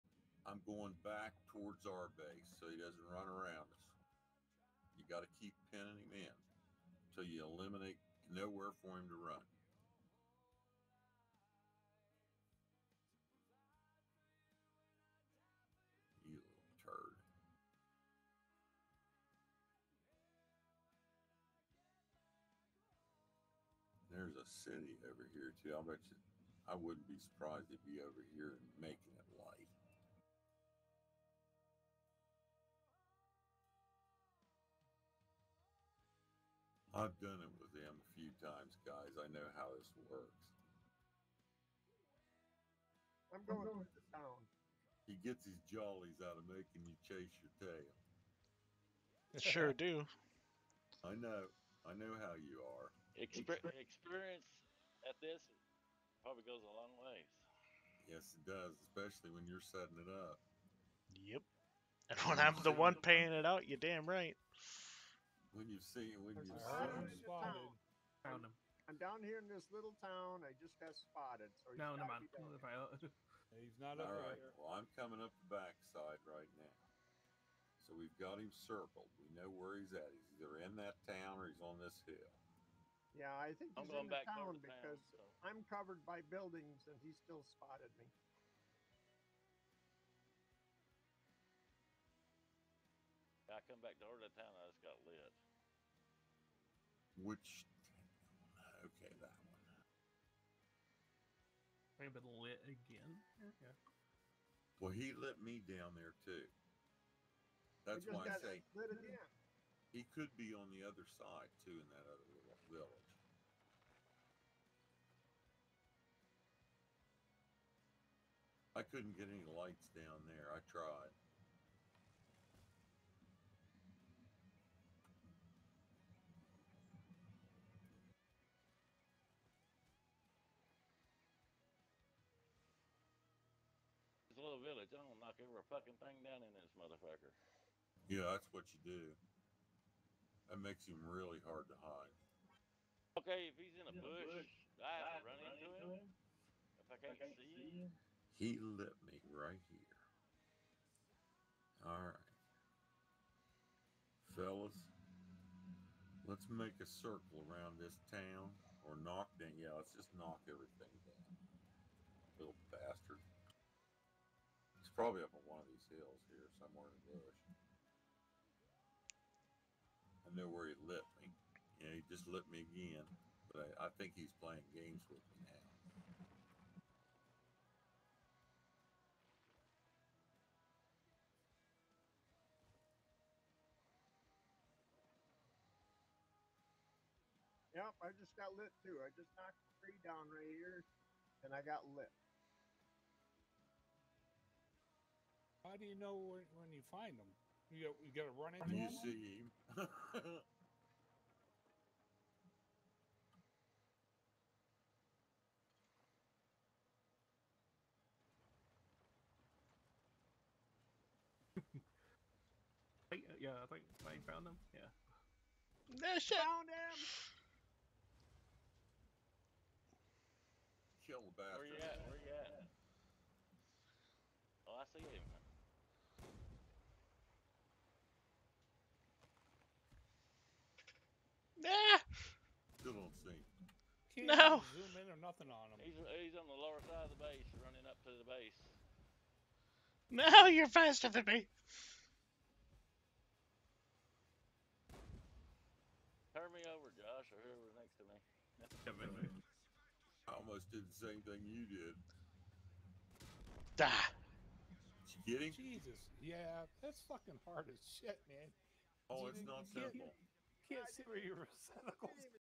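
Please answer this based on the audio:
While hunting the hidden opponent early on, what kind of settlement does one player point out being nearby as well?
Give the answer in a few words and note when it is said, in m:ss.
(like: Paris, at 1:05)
city, at 0:24.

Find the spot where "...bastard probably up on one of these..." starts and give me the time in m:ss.
2:42.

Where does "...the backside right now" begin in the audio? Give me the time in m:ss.
1:15.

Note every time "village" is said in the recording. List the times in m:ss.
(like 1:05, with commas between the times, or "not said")
1:52, 2:14.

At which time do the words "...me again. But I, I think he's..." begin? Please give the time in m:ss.
2:52.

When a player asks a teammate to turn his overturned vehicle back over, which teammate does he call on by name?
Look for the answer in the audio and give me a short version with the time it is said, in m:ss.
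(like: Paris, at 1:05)
Josh, at 4:06.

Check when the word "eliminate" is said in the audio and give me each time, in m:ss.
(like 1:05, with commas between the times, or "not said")
0:07.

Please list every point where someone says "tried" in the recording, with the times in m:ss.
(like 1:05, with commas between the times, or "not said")
2:00.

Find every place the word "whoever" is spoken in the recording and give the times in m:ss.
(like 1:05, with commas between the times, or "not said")
4:07.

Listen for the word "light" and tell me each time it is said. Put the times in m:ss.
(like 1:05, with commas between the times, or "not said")
0:29, 1:59.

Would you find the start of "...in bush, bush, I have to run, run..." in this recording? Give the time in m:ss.
2:23.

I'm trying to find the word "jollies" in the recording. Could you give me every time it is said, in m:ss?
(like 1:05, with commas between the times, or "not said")
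0:45.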